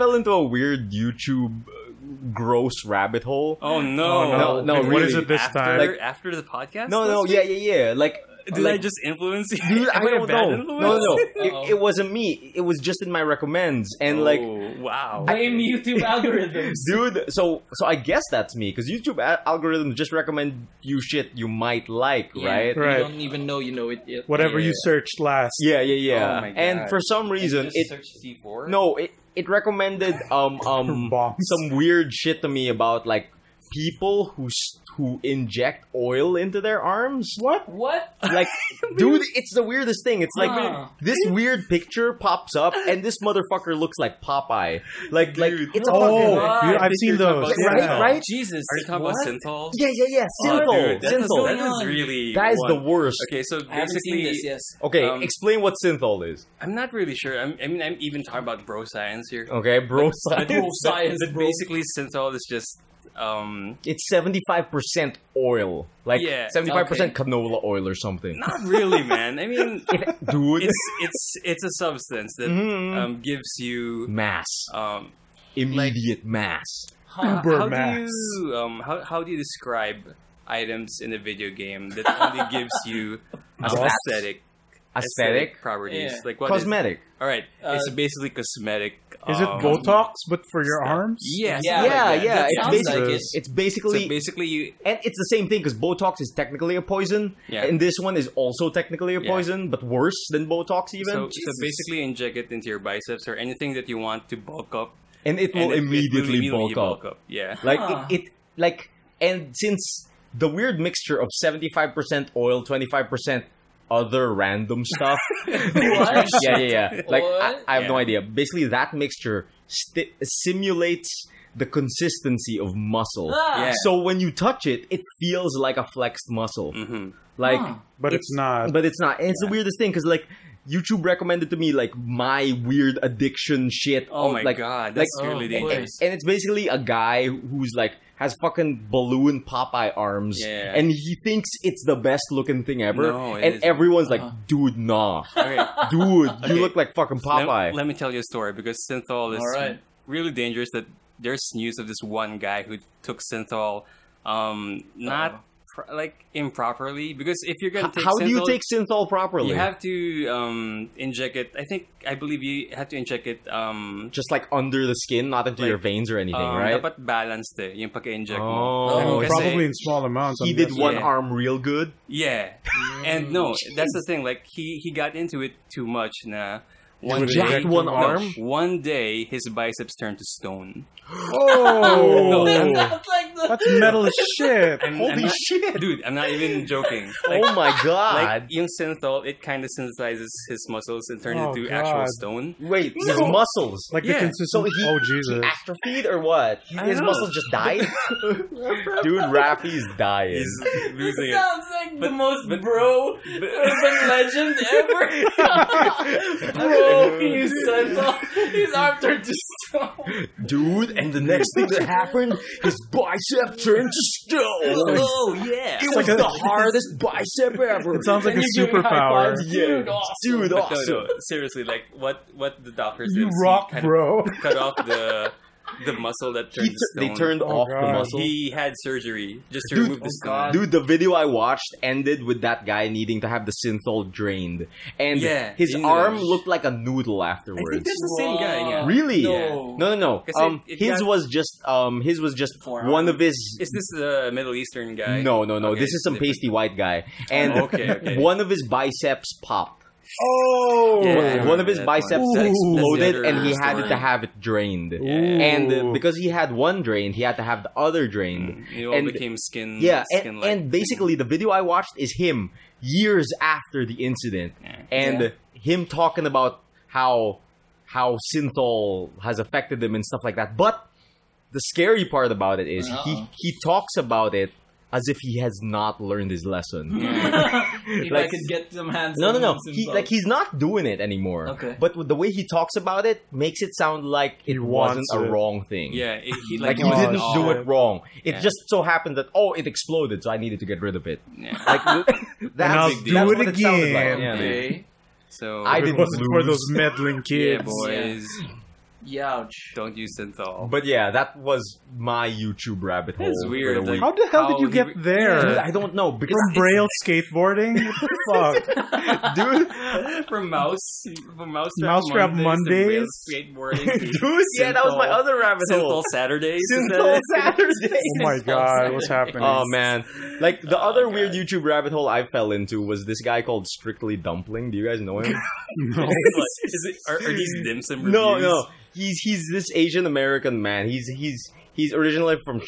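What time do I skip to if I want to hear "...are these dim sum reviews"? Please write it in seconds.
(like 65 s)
327 s.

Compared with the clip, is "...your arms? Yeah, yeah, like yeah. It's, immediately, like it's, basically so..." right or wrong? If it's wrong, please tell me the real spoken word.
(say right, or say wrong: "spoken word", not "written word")
wrong: "basically", not "immediately".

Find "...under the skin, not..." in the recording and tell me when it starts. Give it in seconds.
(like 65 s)
164 s.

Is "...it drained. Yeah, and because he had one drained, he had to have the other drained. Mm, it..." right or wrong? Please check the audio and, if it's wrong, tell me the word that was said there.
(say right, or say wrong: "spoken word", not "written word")
right.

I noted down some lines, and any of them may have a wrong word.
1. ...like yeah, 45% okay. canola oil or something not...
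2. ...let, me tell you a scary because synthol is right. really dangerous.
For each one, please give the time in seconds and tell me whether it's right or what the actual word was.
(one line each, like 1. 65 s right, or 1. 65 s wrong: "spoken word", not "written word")
1. 66 s wrong: "75", not "45"
2. 147 s wrong: "story", not "scary".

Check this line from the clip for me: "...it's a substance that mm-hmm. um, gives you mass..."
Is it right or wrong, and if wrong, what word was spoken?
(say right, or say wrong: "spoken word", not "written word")
right.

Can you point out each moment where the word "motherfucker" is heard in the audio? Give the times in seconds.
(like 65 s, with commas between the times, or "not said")
43 s.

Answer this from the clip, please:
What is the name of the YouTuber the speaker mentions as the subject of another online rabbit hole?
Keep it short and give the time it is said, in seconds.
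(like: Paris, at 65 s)
Strictly Dumpling, at 323 s.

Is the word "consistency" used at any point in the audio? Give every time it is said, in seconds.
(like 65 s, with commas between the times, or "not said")
121 s, 194 s.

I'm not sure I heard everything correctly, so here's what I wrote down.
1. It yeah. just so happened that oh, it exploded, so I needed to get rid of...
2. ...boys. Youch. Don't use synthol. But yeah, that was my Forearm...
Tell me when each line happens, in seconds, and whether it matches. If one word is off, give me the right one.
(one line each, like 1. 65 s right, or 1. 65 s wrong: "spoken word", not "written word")
1. 288 s right
2. 297 s wrong: "YouTube", not "Forearm".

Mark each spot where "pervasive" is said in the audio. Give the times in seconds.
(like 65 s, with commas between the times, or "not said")
not said.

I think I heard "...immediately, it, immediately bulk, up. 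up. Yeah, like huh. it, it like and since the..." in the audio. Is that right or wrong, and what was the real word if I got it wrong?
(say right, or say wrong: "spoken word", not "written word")
right.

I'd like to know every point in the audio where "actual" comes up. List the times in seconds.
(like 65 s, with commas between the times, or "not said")
191 s.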